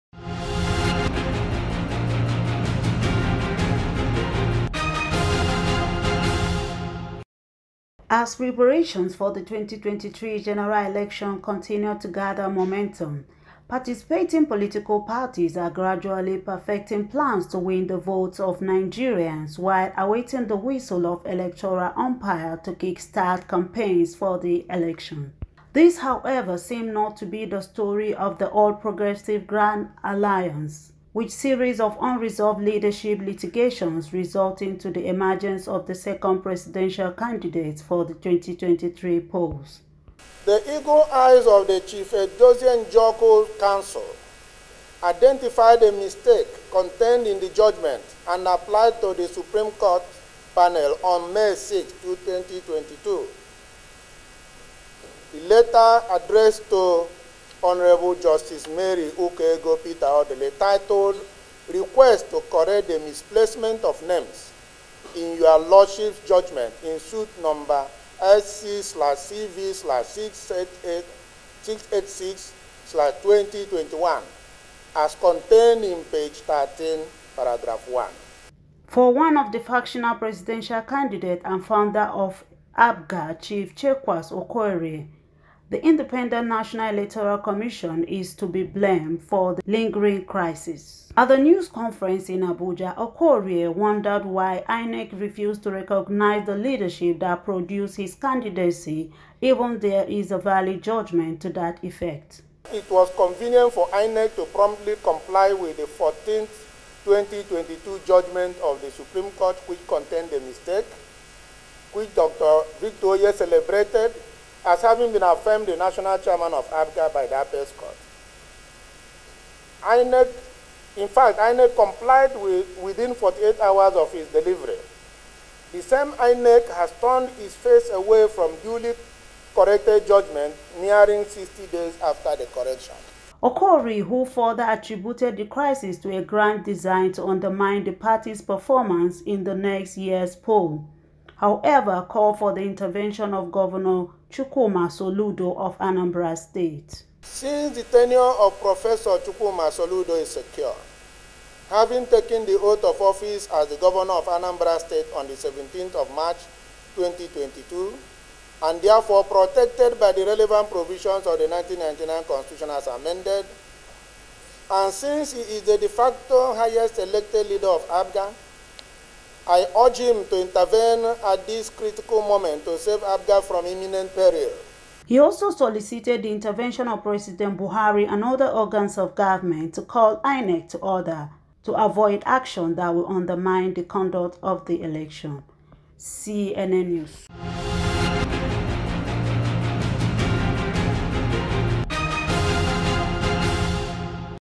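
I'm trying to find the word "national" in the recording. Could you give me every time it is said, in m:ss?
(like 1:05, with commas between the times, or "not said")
1:26, 1:55.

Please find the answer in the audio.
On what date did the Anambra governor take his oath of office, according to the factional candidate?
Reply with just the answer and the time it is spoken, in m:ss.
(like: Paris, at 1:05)
17 March 2022, at 2:35.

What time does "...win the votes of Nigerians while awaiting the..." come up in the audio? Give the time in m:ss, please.
0:17.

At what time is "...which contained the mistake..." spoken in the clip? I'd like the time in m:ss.
1:49.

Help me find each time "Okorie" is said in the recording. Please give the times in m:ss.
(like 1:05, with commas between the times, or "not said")
1:24, 1:32, 2:13.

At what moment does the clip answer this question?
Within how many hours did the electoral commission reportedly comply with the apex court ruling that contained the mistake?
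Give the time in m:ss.
2:03.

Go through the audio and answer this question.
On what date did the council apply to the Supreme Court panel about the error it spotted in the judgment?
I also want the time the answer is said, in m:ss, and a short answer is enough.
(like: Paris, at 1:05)
May 6, 2022, at 0:51.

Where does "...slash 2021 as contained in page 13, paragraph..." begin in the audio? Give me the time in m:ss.
1:12.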